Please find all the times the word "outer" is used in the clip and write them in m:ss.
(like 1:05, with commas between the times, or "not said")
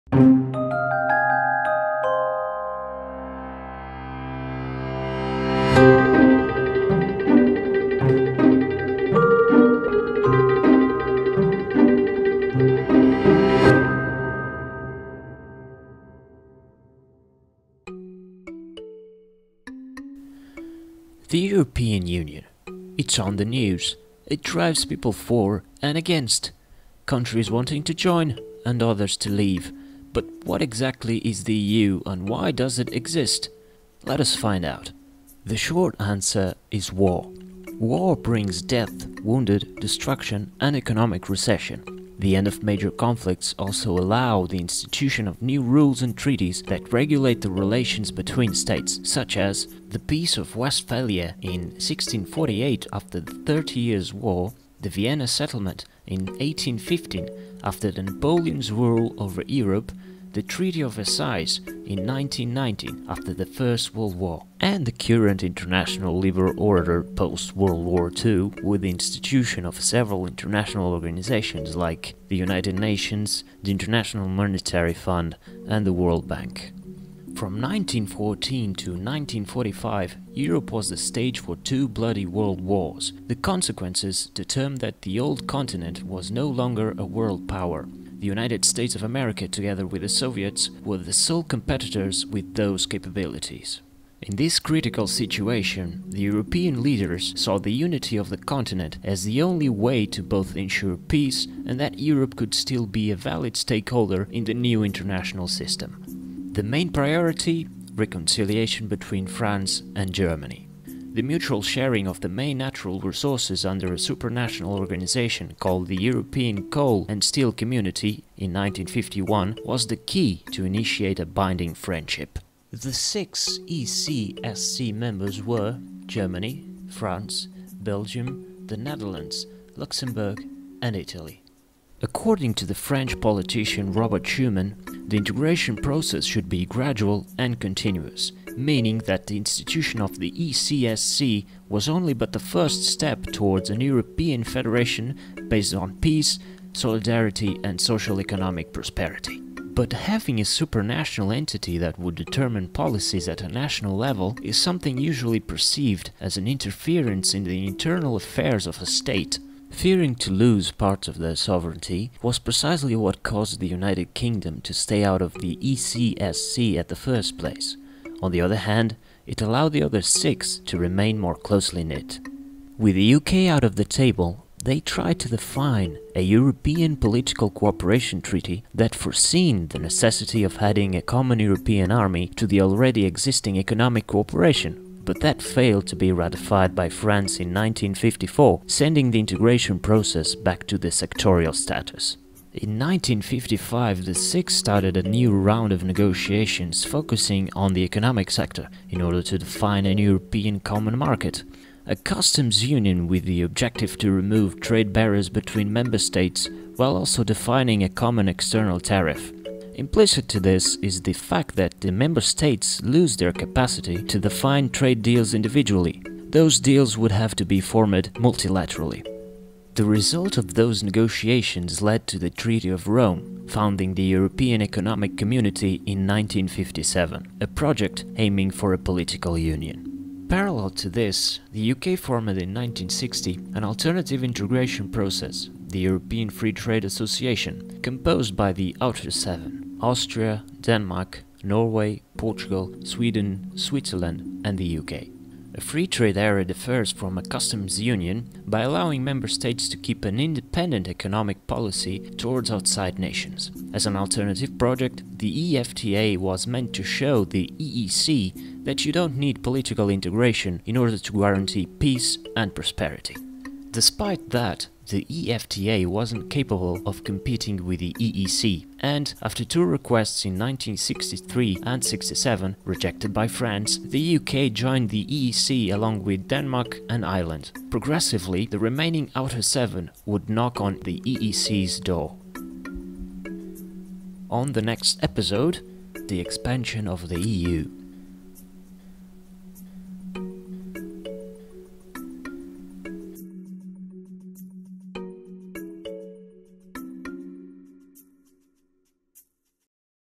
3:58, 4:39.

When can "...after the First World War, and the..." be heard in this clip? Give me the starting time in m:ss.
1:03.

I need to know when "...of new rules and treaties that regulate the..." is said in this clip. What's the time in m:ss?
0:45.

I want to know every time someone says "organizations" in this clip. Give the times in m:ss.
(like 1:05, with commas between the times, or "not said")
1:10, 1:54.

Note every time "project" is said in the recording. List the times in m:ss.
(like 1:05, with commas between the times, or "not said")
3:47, 4:14.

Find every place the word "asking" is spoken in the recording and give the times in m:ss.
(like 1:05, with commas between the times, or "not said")
not said.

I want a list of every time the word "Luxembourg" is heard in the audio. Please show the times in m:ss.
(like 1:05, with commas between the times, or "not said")
2:09.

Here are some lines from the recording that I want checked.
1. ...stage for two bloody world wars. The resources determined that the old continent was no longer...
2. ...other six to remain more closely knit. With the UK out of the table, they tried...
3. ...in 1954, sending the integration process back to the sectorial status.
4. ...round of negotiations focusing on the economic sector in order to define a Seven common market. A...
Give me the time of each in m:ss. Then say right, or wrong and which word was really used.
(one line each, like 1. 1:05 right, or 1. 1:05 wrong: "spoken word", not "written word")
1. 1:20 wrong: "consequences", not "resources"
2. 2:49 right
3. 3:07 right
4. 3:15 wrong: "European", not "Seven".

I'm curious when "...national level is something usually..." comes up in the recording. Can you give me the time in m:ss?
2:33.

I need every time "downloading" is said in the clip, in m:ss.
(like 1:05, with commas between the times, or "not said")
not said.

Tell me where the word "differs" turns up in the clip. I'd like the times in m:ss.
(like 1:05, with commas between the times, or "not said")
4:06.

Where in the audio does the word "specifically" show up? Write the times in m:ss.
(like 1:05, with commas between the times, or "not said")
not said.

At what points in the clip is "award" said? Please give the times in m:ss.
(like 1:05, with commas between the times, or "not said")
not said.